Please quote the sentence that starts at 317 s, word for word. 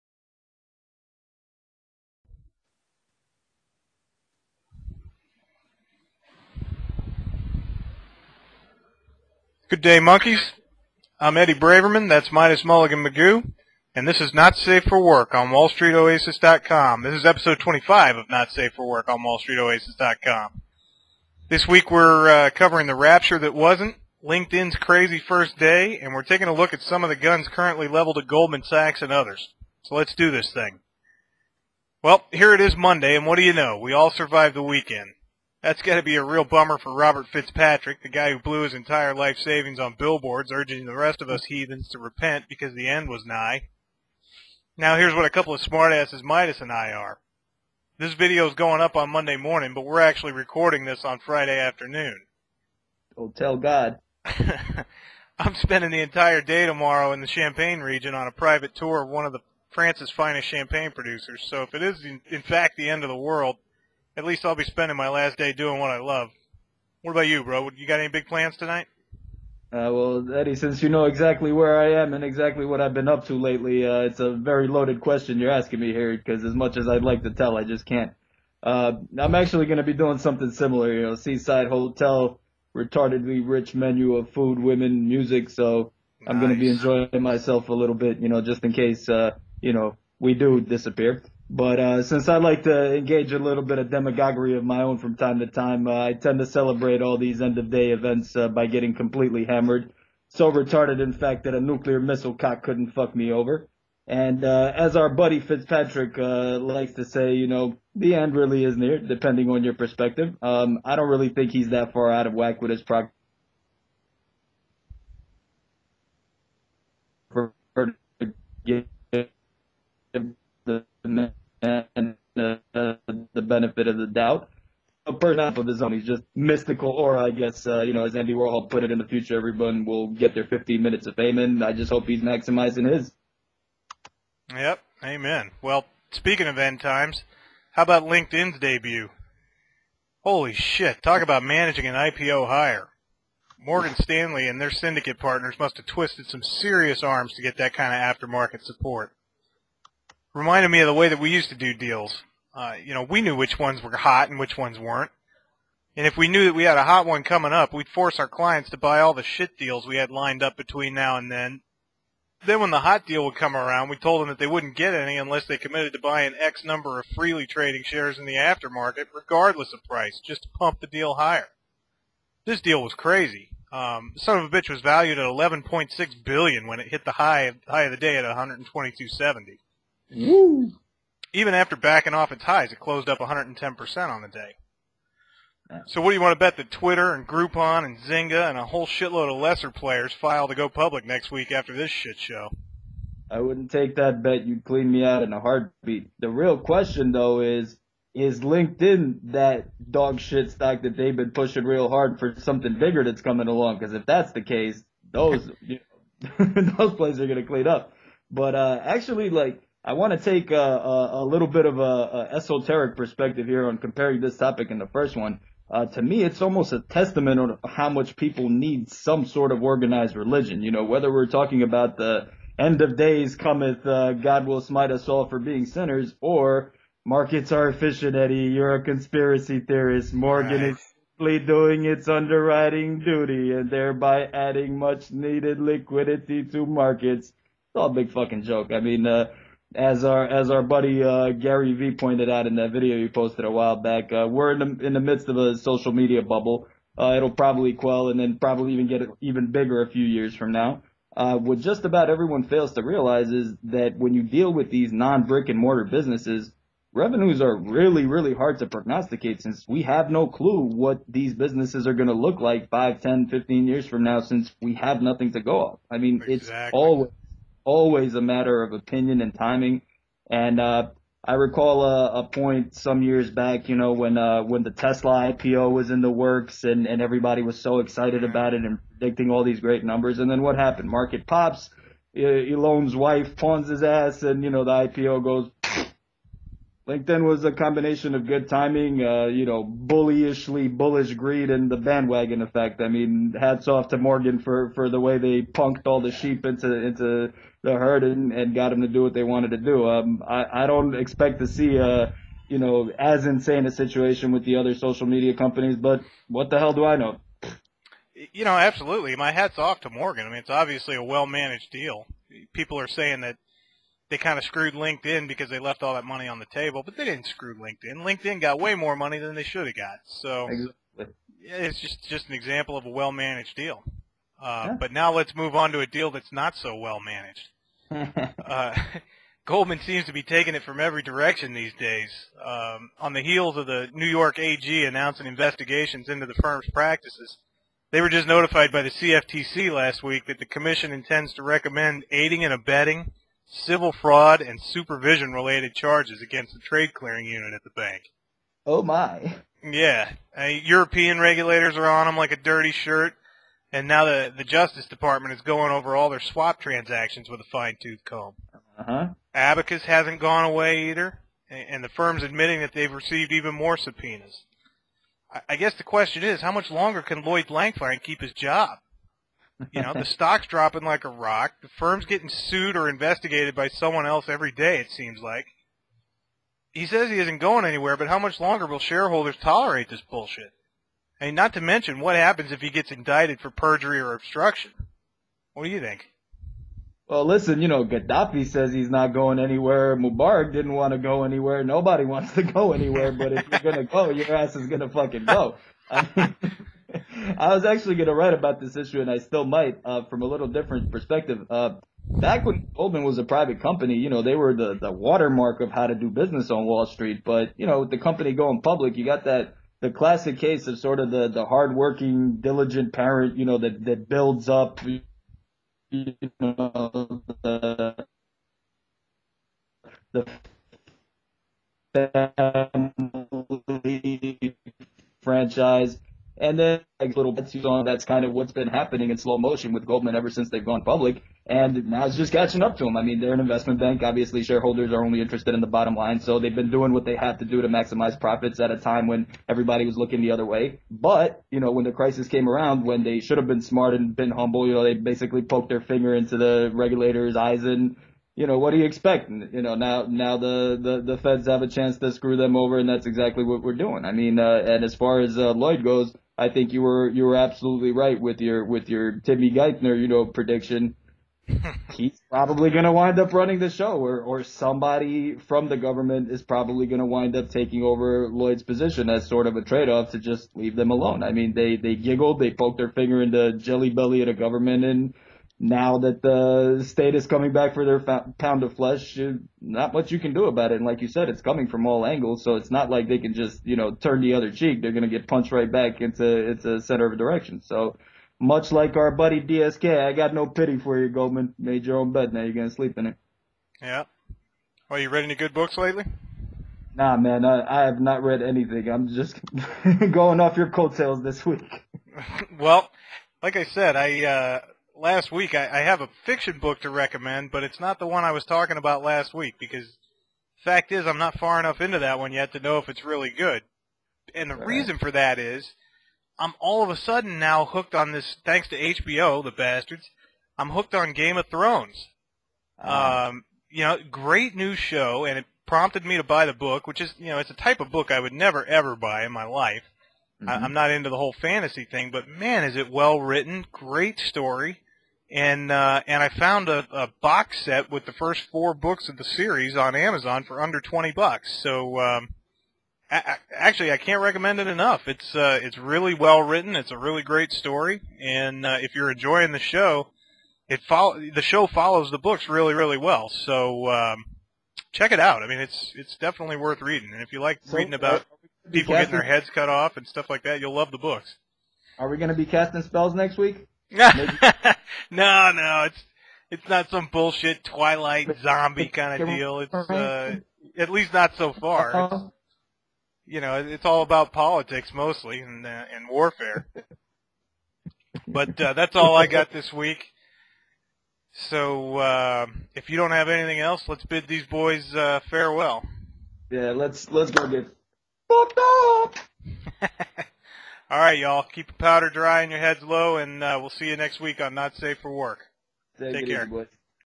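LinkedIn got way more money than they should have got.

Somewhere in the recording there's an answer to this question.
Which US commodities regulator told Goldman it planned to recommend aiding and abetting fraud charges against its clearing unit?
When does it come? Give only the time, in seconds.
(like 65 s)
338 s.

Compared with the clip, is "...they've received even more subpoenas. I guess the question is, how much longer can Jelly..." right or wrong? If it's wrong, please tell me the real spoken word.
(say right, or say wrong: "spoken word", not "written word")
wrong: "Lloyd", not "Jelly".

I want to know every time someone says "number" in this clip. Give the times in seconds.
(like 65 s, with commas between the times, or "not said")
166 s, 279 s.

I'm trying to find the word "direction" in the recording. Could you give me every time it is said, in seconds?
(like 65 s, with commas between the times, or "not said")
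331 s, 487 s.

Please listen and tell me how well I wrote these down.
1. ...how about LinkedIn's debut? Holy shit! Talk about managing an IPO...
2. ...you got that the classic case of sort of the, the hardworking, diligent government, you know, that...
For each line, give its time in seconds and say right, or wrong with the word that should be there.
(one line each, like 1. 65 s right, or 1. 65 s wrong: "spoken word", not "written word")
1. 137 s right
2. 408 s wrong: "parent", not "government".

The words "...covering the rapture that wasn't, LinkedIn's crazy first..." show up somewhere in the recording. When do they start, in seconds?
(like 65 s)
22 s.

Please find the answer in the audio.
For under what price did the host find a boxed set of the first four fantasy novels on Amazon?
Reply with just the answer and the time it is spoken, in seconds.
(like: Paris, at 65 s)
$20, at 540 s.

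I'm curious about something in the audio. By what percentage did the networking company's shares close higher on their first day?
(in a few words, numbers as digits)
110%.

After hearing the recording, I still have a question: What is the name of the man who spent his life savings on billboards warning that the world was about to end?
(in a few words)
Robert Fitzpatrick.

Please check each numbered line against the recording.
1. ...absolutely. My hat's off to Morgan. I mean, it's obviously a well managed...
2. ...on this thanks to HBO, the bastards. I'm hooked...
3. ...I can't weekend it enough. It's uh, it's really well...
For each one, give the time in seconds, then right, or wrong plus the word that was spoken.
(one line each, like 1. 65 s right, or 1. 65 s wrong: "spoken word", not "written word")
1. 308 s right
2. 517 s right
3. 543 s wrong: "recommend", not "weekend".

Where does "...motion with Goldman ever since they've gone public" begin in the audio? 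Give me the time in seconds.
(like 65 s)
429 s.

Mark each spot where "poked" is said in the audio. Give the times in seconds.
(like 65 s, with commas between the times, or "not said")
445 s, 472 s.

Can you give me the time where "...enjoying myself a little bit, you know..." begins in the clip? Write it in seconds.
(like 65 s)
86 s.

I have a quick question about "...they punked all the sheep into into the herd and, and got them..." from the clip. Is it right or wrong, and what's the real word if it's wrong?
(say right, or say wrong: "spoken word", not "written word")
right.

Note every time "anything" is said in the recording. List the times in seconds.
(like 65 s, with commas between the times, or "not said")
498 s, 583 s.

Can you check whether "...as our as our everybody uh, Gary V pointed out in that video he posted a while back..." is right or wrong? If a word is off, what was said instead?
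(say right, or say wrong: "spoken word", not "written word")
wrong: "buddy", not "everybody".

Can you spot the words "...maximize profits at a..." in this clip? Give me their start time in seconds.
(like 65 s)
437 s.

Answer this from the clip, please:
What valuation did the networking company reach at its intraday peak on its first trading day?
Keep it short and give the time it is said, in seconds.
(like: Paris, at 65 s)
11.6 billion, at 175 s.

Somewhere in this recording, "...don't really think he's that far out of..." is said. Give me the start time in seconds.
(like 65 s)
110 s.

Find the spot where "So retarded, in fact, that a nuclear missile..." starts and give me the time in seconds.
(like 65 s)
100 s.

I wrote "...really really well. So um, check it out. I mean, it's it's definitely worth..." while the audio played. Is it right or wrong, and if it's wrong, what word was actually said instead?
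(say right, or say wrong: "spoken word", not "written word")
right.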